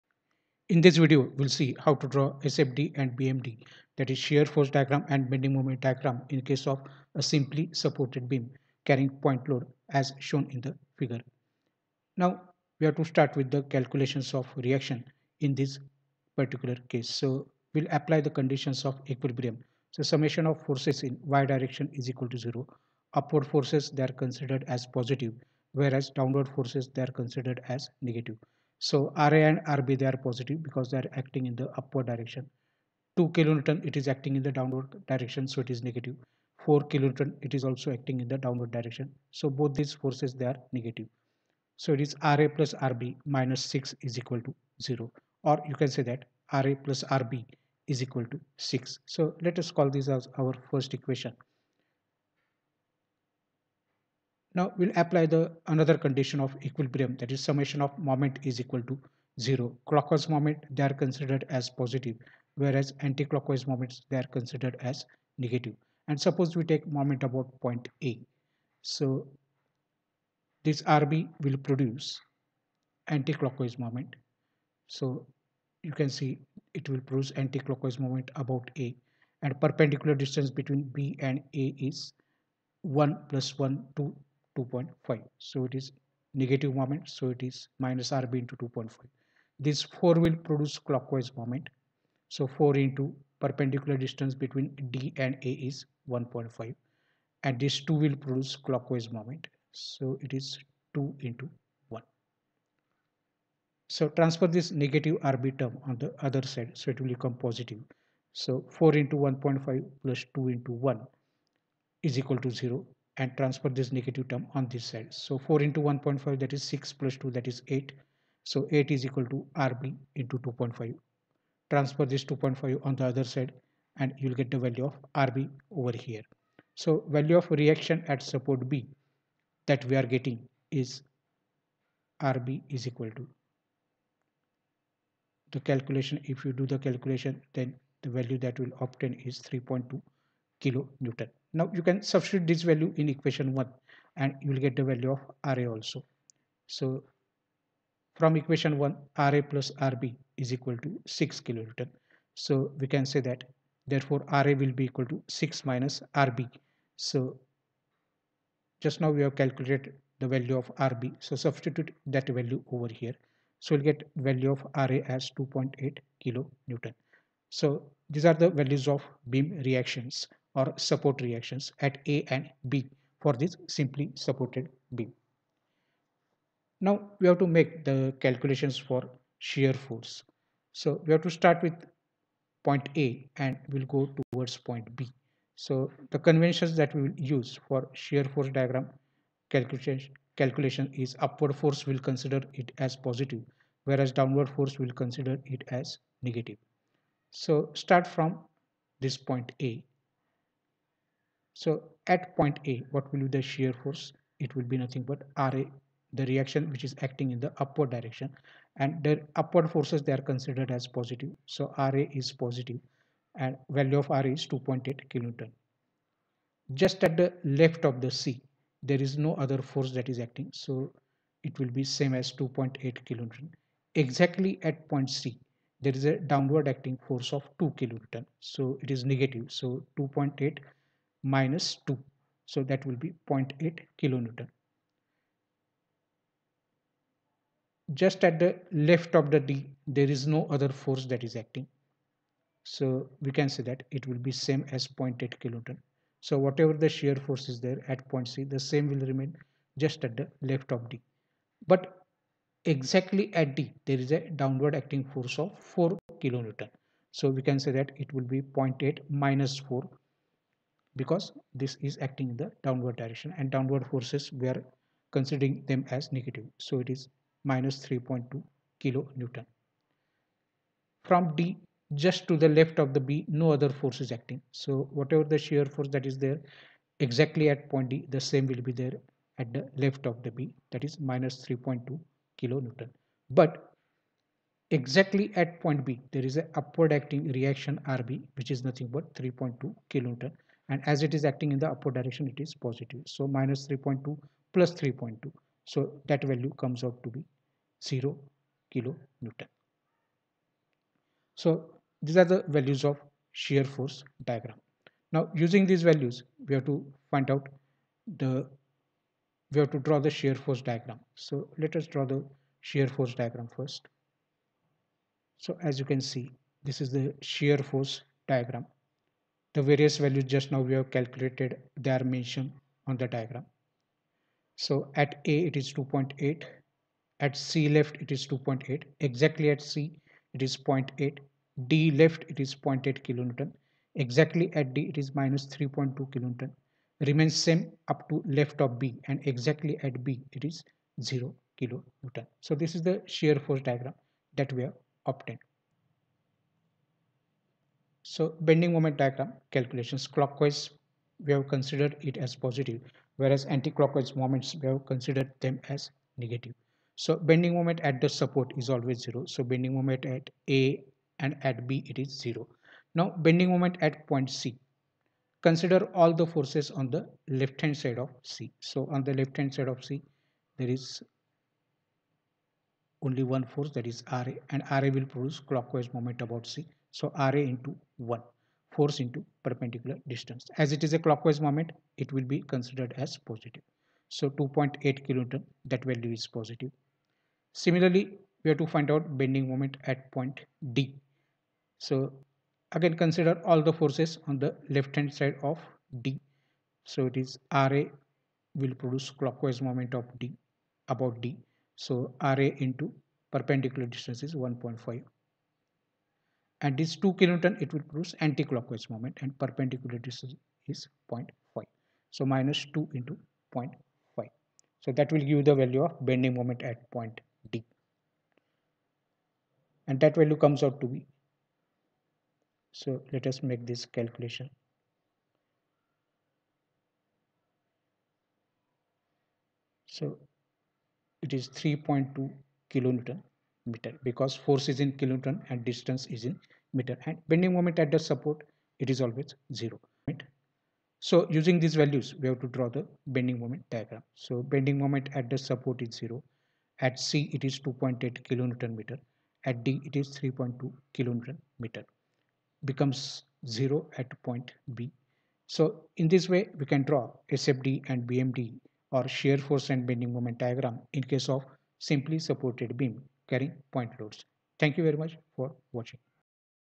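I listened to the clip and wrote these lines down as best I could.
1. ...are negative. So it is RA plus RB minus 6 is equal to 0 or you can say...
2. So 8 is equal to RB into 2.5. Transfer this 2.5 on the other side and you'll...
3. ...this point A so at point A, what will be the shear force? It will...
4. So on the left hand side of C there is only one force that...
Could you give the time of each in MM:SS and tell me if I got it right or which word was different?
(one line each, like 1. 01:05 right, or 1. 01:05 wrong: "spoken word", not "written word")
1. 00:40 right
2. 01:58 right
3. 03:18 right
4. 06:08 right.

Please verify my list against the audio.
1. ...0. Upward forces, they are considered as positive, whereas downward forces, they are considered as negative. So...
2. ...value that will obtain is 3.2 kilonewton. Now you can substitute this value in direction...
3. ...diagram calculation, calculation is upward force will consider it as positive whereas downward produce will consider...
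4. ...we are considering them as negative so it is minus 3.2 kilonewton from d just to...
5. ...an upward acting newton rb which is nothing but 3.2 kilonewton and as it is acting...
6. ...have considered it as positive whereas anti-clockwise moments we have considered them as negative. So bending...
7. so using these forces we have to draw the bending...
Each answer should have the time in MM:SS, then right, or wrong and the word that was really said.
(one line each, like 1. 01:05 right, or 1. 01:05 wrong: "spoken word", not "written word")
1. 00:22 right
2. 02:18 wrong: "equation", not "direction"
3. 03:08 wrong: "force", not "produce"
4. 04:24 right
5. 04:46 wrong: "reaction", not "newton"
6. 05:51 right
7. 07:20 wrong: "values", not "forces".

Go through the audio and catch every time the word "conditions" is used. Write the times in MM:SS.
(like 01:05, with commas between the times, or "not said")
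00:18, 00:55.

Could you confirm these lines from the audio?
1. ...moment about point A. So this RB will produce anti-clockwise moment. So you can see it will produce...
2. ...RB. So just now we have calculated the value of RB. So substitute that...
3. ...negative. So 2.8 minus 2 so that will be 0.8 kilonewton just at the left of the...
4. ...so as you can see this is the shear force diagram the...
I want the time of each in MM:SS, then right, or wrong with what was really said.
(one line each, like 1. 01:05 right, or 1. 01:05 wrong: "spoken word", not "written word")
1. 01:06 right
2. 02:36 right
3. 03:49 right
4. 05:15 right.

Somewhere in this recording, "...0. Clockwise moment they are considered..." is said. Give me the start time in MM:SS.
00:59.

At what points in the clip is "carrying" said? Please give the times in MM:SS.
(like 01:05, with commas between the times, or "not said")
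00:08, 07:43.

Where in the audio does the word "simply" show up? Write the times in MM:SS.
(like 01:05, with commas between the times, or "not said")
00:07, 02:53, 07:41.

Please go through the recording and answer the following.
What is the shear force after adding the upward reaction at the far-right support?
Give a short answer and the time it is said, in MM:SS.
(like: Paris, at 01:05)
0 kilonewton, at 04:57.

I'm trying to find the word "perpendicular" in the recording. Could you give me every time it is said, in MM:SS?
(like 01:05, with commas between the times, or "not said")
01:19, 01:33, 06:19, 06:43, 06:49.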